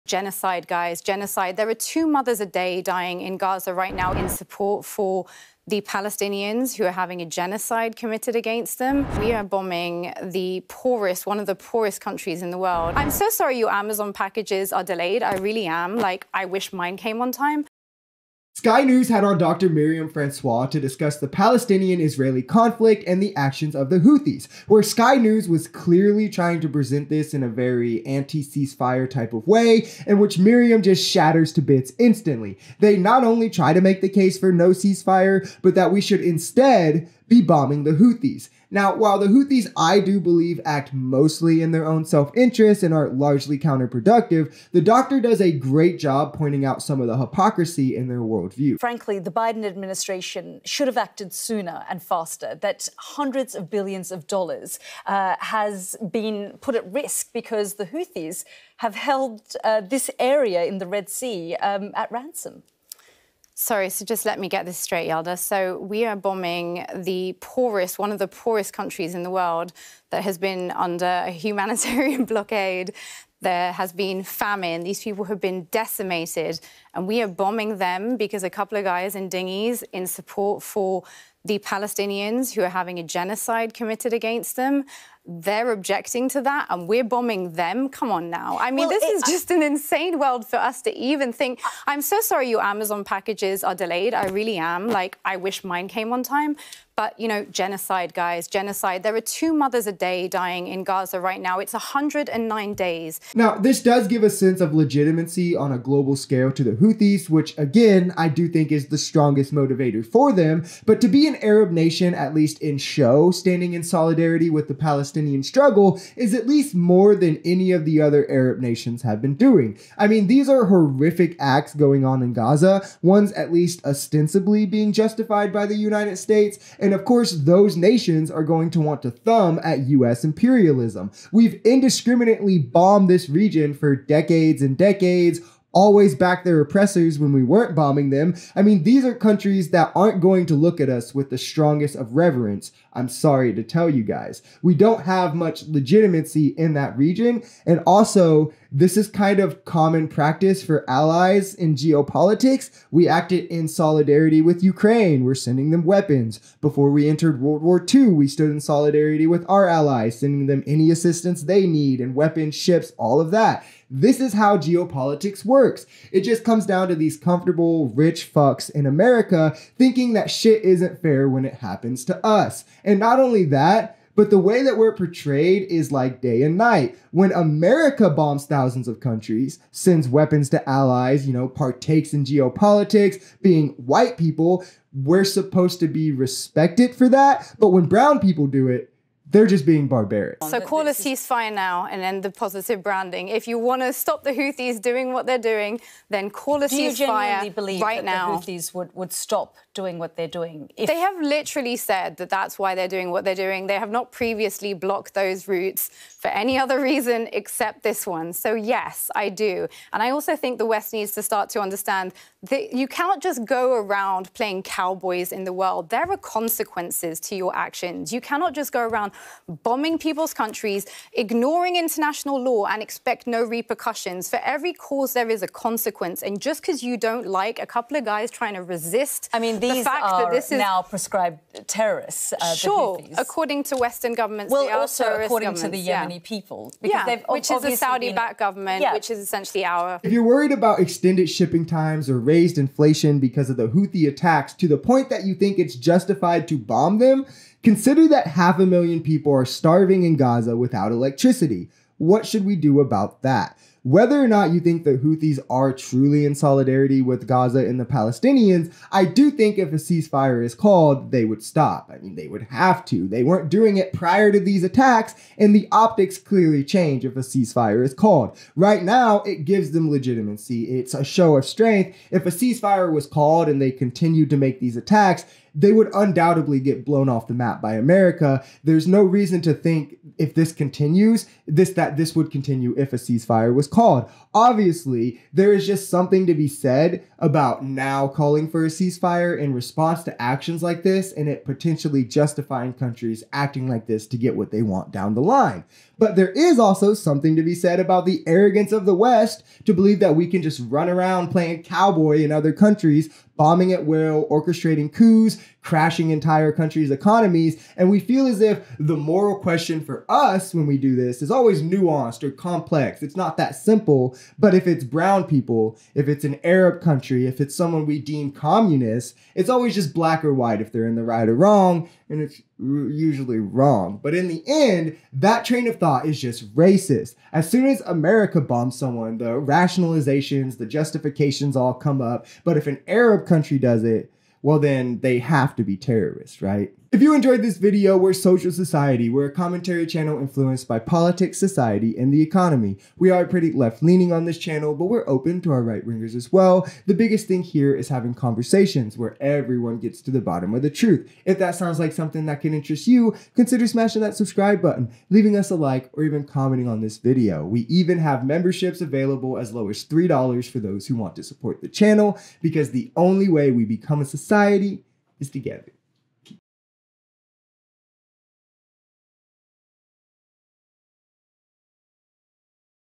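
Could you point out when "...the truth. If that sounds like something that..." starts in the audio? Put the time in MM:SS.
05:50.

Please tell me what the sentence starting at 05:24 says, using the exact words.
But in the end, that train of thought is just racist.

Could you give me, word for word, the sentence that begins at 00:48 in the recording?
Frankly, the Biden administration should have acted sooner and faster.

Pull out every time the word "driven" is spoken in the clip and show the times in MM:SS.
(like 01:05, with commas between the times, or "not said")
not said.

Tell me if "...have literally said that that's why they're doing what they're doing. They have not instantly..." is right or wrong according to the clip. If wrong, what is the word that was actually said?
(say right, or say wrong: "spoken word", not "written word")
wrong: "previously", not "instantly".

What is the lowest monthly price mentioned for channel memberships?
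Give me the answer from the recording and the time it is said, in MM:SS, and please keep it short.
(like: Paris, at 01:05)
$3, at 05:59.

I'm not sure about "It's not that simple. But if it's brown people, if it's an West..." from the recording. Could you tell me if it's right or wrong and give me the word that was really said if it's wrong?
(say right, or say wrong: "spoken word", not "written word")
wrong: "Arab", not "West".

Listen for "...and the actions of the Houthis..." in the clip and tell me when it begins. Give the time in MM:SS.
00:23.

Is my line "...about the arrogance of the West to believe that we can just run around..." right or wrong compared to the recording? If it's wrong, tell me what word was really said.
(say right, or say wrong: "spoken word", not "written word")
right.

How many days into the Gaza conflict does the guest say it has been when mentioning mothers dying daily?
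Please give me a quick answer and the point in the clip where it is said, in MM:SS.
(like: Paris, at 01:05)
109 days, at 01:41.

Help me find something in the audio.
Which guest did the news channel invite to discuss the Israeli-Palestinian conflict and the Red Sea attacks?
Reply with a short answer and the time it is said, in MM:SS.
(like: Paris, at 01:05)
Dr. Myriam François, at 00:19.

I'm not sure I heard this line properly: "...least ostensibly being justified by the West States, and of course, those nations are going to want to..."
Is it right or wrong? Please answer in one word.
wrong.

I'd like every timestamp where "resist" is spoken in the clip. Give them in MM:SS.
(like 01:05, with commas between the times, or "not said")
03:48.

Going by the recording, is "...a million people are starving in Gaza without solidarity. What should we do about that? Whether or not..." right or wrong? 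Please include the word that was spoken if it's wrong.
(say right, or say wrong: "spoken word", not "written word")
wrong: "electricity", not "solidarity".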